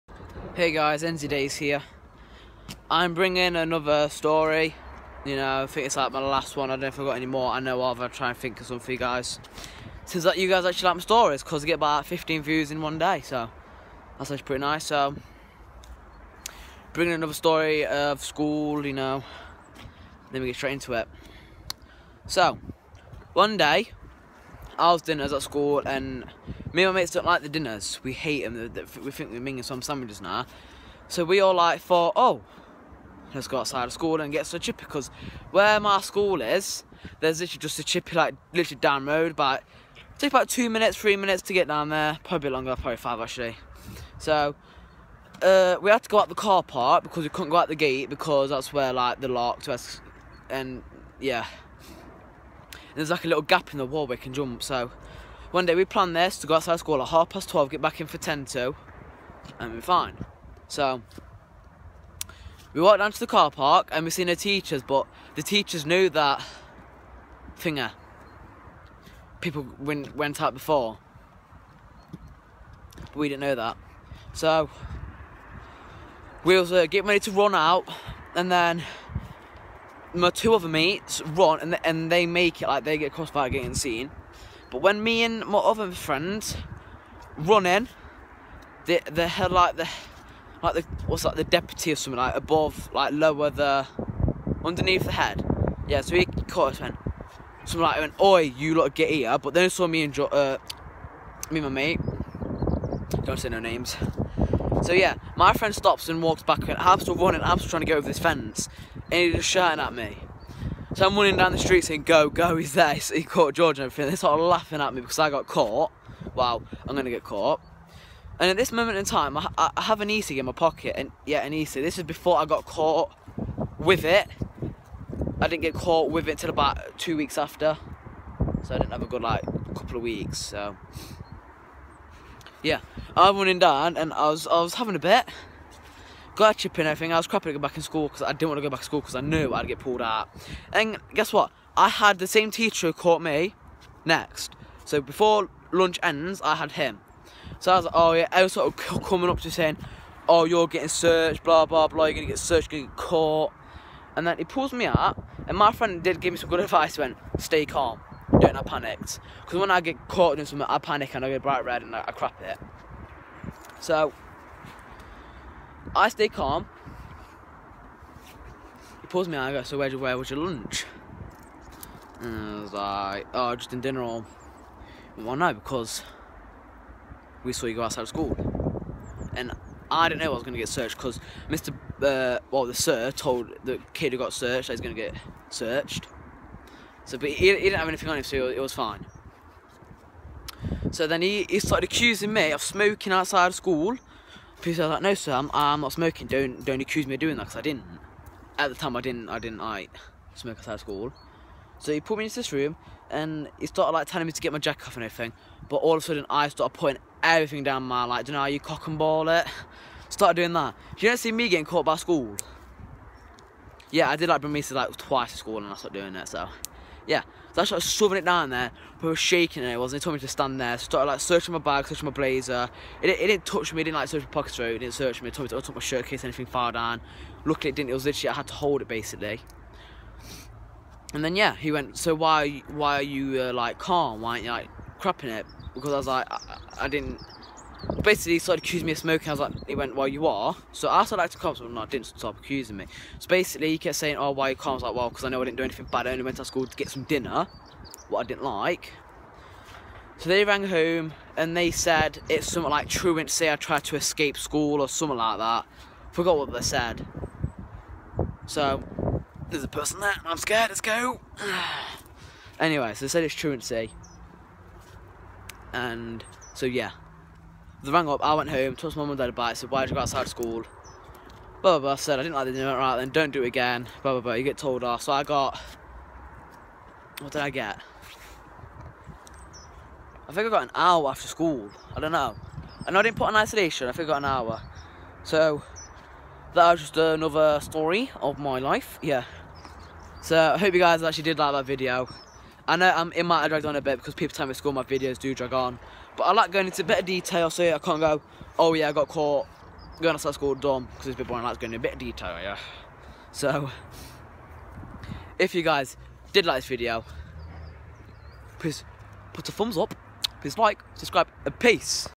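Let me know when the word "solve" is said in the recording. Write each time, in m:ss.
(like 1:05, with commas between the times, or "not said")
not said.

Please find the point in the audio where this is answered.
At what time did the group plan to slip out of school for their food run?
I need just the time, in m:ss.
0:57.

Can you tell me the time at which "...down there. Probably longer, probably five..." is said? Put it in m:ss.
0:41.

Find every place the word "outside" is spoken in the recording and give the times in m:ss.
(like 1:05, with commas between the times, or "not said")
0:33, 0:56, 2:57, 3:13, 3:20, 4:30.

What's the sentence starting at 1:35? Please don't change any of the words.
Yeah, so he caught us and something like, went, oi, you lot get here.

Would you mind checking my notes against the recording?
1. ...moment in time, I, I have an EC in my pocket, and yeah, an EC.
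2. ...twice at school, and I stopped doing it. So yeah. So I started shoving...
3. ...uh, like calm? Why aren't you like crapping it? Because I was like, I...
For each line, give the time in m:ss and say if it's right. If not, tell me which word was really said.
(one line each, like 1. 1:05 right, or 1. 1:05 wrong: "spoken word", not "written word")
1. 1:58 right
2. 3:34 right
3. 3:53 right.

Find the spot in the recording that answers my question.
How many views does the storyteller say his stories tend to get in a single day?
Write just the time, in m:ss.
0:12.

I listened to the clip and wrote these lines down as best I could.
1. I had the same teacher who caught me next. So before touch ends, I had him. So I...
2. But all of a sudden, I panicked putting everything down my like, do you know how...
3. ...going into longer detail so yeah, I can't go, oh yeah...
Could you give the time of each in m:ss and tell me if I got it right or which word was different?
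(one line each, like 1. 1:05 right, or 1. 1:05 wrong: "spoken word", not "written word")
1. 2:21 wrong: "lunch", not "touch"
2. 3:25 wrong: "started", not "panicked"
3. 4:56 wrong: "better", not "longer".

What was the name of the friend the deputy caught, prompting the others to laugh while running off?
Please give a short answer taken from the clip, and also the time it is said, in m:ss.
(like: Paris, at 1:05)
George, at 1:53.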